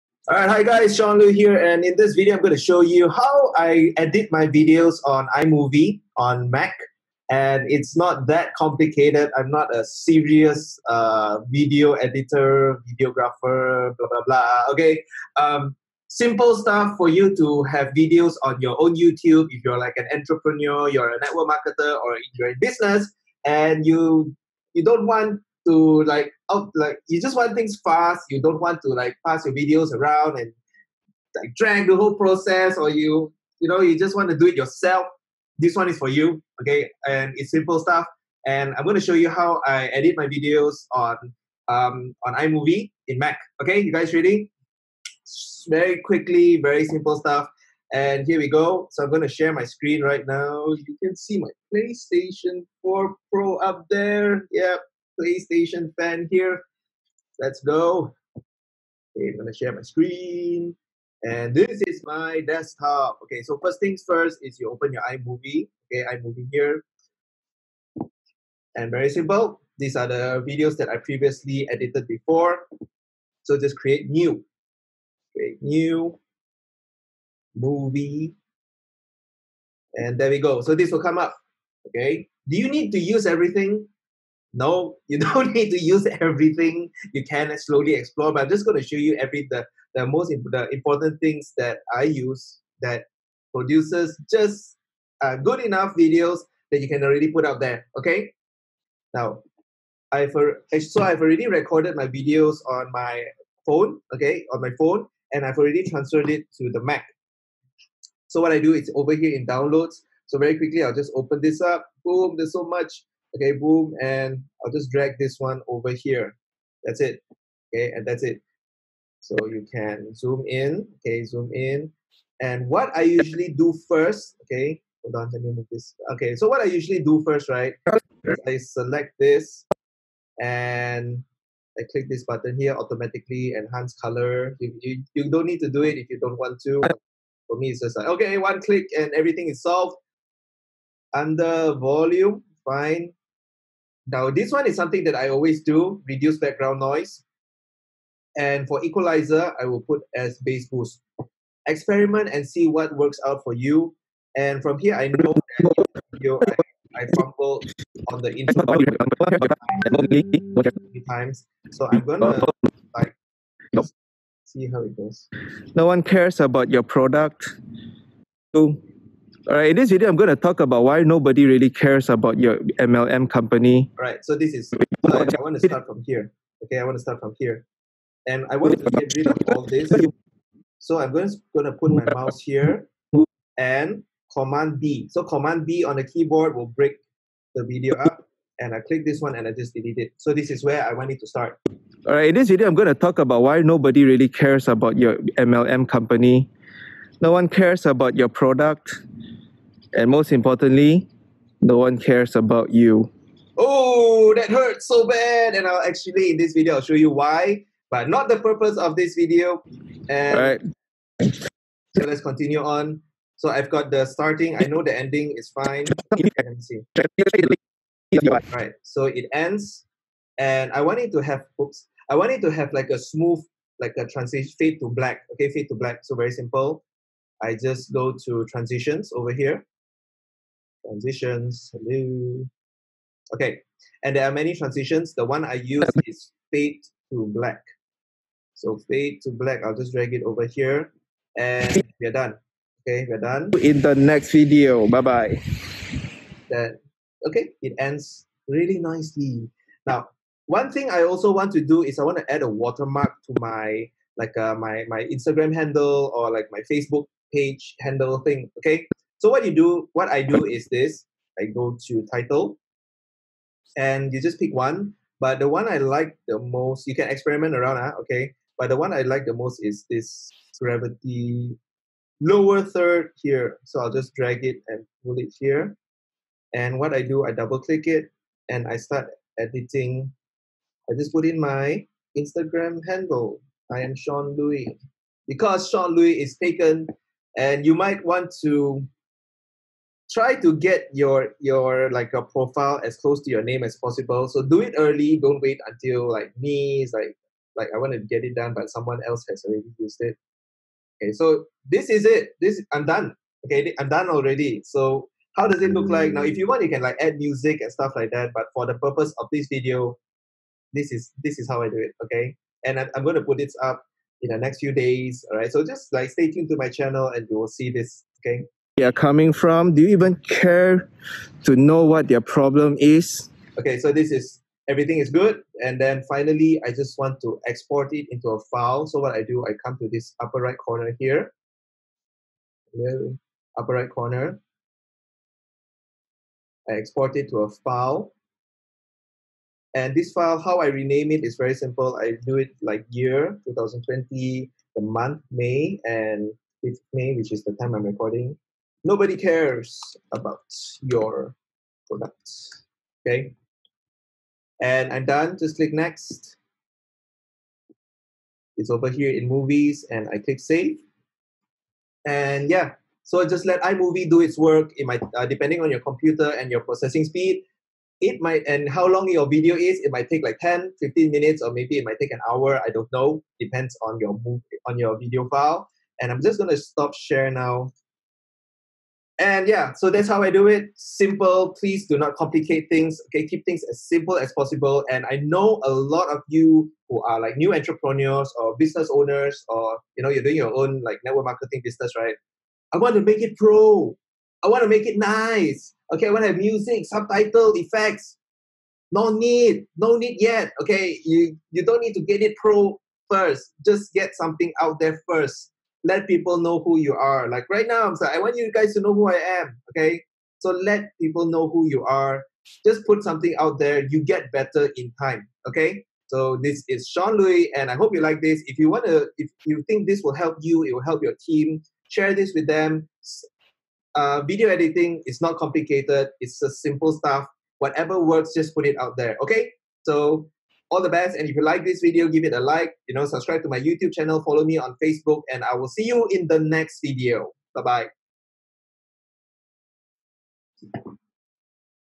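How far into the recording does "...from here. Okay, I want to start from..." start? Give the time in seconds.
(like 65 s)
175 s.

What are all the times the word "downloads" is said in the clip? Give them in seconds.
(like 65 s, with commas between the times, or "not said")
109 s.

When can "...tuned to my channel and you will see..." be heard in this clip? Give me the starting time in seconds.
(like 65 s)
316 s.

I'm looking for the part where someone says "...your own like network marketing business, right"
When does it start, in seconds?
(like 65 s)
390 s.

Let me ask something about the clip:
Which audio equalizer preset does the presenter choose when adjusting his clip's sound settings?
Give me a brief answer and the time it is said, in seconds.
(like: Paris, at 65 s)
Bass boost, at 150 s.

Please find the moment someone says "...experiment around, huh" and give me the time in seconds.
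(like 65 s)
267 s.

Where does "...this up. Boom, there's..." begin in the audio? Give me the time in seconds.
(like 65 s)
111 s.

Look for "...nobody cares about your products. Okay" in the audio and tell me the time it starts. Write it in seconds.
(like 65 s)
348 s.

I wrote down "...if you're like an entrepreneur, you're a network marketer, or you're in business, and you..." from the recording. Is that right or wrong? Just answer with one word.
right.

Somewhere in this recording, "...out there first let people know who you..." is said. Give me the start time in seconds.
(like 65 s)
404 s.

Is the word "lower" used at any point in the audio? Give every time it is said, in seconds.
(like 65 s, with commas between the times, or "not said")
272 s.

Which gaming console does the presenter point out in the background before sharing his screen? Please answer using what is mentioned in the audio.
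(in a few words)
PlayStation 4 Pro.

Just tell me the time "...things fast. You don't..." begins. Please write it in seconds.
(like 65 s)
27 s.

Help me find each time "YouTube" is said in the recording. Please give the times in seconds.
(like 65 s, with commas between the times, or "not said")
18 s, 433 s.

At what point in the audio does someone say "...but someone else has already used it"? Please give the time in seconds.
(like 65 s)
298 s.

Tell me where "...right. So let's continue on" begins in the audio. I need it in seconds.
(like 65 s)
210 s.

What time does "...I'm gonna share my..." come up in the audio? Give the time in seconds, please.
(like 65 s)
59 s.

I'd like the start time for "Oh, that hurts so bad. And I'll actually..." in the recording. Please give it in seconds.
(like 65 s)
203 s.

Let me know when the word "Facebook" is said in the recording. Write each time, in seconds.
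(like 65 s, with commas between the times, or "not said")
256 s, 434 s.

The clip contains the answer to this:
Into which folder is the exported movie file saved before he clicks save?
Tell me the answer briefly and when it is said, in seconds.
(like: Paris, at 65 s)
Movies, at 359 s.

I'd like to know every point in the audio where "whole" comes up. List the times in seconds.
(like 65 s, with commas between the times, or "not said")
31 s.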